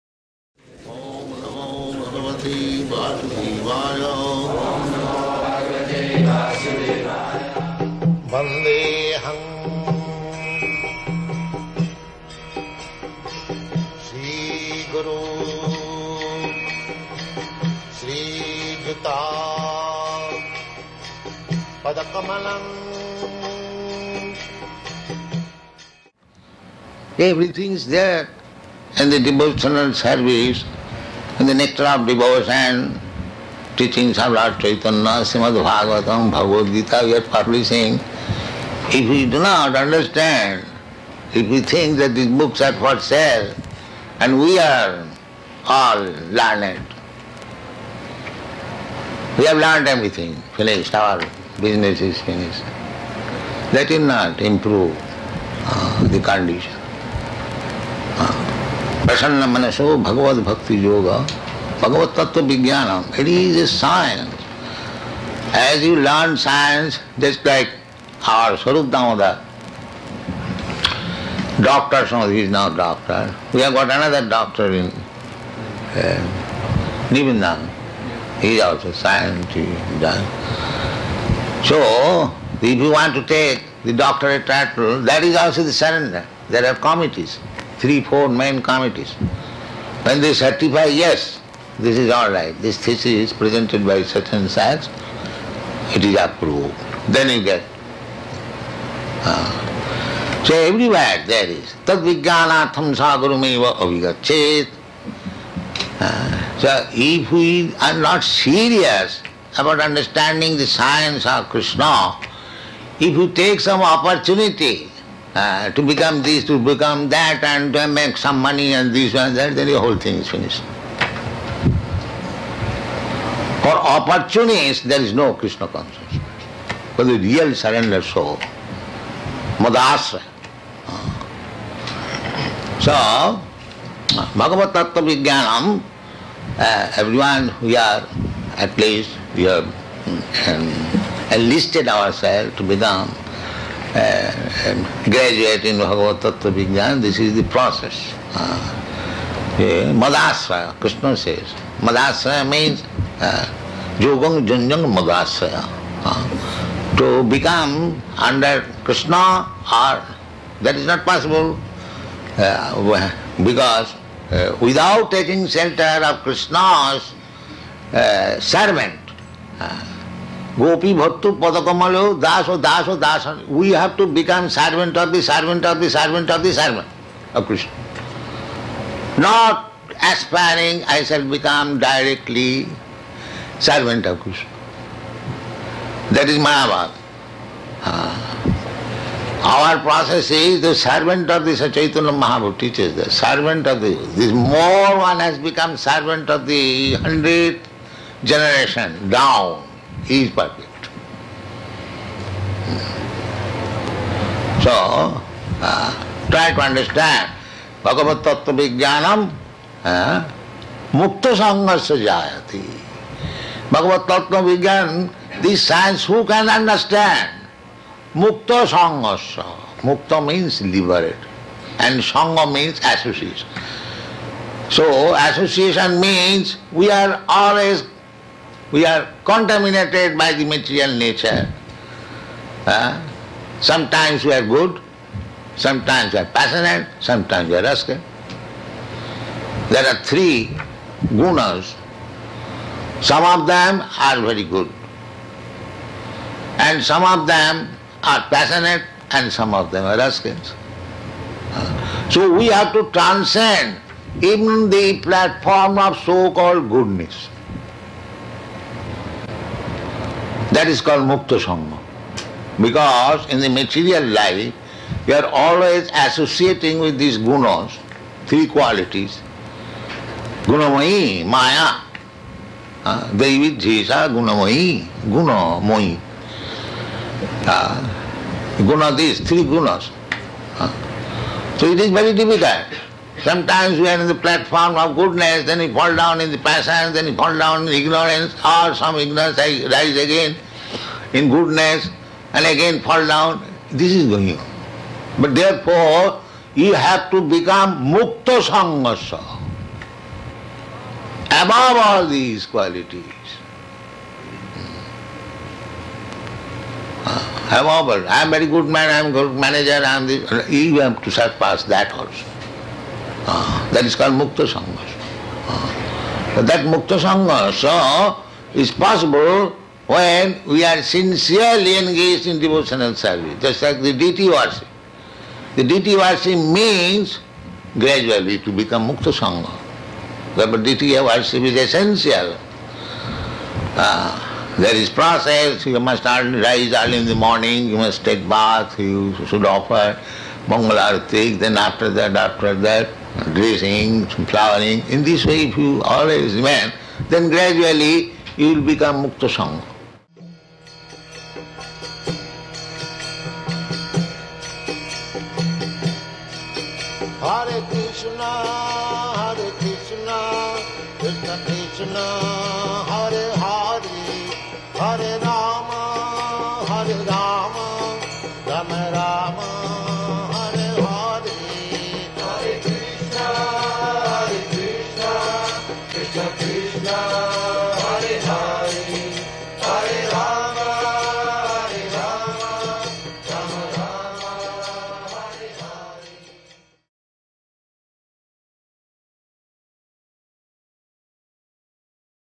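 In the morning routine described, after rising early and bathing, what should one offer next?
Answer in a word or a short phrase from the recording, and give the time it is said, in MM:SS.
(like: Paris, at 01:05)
mangalartik, at 05:40.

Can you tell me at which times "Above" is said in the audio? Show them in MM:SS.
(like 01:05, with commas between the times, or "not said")
05:01, 05:07.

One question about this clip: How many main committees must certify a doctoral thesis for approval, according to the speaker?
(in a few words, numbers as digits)
3 or 4.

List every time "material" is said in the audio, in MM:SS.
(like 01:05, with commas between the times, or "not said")
03:50, 04:23.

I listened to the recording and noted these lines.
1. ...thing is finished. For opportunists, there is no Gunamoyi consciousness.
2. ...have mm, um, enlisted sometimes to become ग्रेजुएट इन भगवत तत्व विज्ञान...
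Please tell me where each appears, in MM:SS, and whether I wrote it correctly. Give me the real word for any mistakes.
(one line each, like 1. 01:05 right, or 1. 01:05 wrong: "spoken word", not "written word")
1. 01:59 wrong: "Krishna", not "Gunamoyi"
2. 02:19 wrong: "ourselves", not "sometimes".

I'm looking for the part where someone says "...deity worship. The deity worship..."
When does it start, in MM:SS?
05:23.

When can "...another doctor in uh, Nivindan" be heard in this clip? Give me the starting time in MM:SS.
01:13.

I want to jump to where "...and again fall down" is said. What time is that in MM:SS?
04:52.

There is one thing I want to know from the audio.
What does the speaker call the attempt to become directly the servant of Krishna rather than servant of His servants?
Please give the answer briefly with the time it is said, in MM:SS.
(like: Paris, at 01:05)
Mayavad, at 03:06.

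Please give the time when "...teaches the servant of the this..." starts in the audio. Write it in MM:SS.
03:12.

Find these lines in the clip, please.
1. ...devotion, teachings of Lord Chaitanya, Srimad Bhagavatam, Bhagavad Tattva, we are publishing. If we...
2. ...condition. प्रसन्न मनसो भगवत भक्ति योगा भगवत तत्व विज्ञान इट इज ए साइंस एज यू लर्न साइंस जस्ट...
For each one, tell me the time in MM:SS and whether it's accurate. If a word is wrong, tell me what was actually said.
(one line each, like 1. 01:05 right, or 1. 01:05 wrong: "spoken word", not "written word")
1. 00:32 wrong: "Gita", not "Tattva"
2. 00:56 right.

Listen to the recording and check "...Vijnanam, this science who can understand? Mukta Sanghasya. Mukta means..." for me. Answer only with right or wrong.
right.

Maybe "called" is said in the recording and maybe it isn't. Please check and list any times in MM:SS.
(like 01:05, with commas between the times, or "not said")
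04:16, 04:20, 05:13.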